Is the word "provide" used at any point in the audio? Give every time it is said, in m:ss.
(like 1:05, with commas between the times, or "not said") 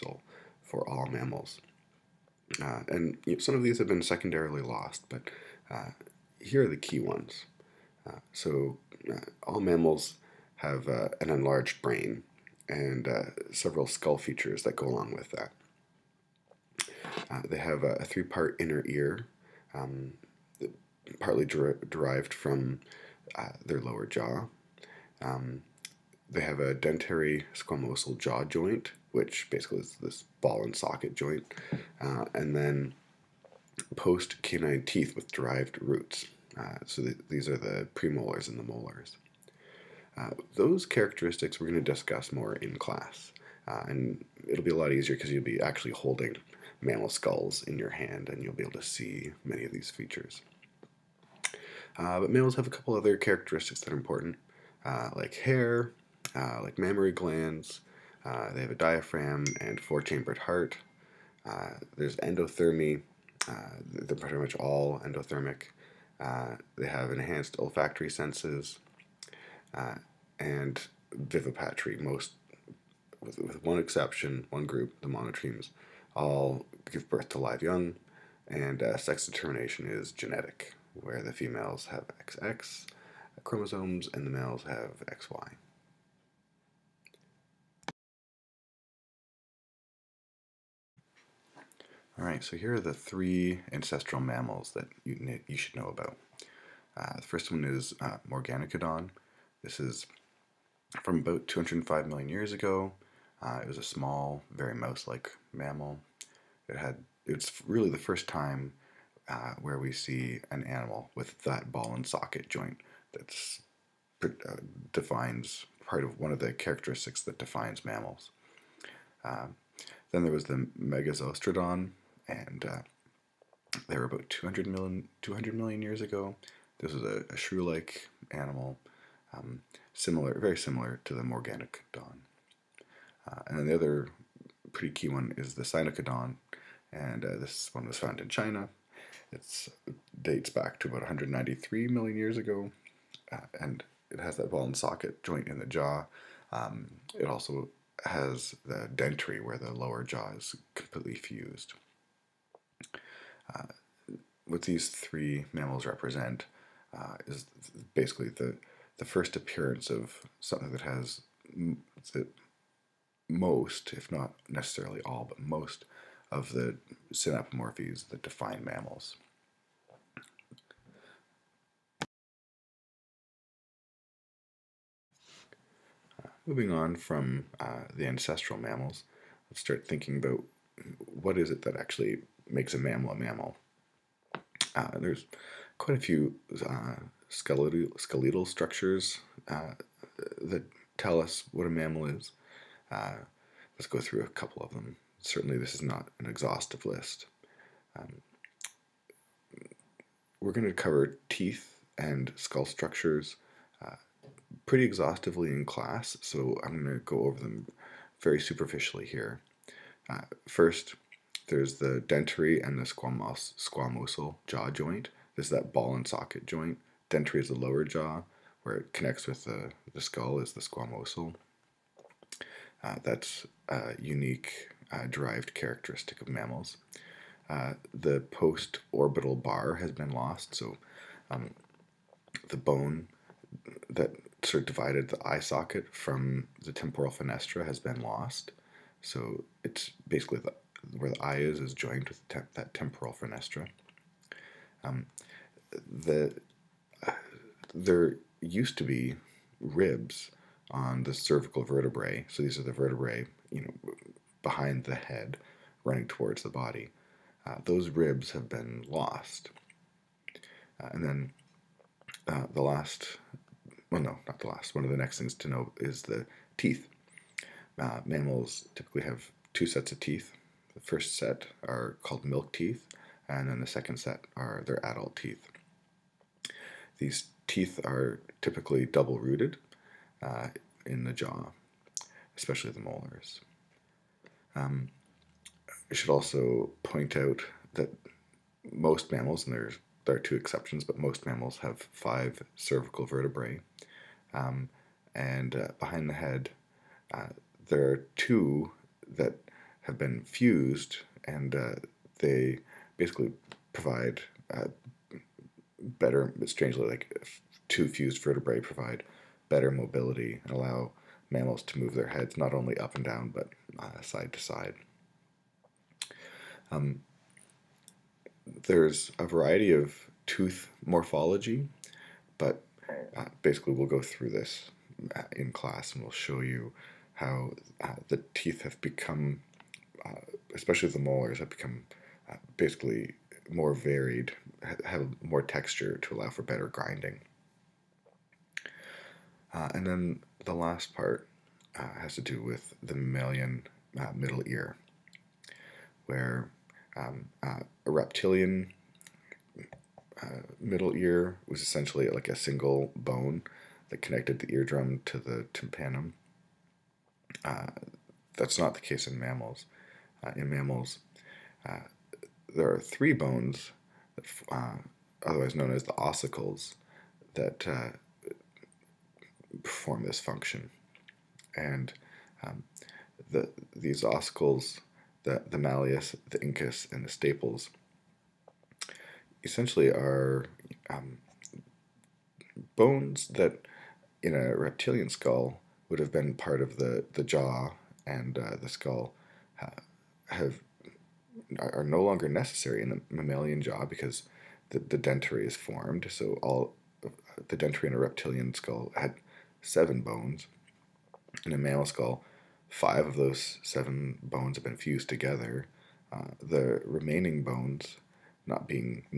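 5:03, 5:08.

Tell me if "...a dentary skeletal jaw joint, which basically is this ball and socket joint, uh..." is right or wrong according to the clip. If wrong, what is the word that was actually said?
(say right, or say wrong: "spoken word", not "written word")
wrong: "squamosal", not "skeletal".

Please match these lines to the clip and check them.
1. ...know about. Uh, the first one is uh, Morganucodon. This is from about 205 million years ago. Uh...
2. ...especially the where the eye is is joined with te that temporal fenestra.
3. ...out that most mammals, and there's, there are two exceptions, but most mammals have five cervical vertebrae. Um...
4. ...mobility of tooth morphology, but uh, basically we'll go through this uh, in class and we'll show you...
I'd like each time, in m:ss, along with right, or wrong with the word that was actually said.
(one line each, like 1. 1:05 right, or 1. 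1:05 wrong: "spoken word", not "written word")
1. 1:35 right
2. 4:00 wrong: "basically", not "especially"
3. 4:47 right
4. 5:19 wrong: "variety", not "mobility".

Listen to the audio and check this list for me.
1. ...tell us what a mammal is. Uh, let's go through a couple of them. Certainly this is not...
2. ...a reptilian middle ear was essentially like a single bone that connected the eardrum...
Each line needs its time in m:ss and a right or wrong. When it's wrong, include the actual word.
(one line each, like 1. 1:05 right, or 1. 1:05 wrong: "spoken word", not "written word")
1. 3:10 right
2. 5:47 right.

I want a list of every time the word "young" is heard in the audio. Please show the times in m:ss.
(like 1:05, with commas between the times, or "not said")
1:17.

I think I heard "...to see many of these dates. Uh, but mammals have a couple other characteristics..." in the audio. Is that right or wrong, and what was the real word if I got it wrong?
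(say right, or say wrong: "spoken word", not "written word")
wrong: "features", not "dates".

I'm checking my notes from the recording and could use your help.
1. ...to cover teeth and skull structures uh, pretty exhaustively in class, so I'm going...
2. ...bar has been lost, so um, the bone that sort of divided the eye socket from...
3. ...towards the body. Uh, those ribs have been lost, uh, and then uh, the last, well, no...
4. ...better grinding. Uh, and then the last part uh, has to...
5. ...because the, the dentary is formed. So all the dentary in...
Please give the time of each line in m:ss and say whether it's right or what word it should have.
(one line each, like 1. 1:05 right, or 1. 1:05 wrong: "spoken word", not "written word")
1. 3:20 right
2. 3:49 right
3. 4:16 right
4. 5:36 right
5. 6:33 right.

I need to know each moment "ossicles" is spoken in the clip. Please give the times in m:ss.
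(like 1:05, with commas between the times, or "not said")
6:05, 6:14.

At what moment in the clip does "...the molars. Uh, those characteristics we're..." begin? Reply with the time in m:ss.
0:38.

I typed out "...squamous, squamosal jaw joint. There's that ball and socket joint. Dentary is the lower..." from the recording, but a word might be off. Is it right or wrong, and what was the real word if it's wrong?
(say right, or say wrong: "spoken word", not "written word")
right.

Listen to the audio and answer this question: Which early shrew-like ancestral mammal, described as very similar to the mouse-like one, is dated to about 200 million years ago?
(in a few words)
Megazostrodon.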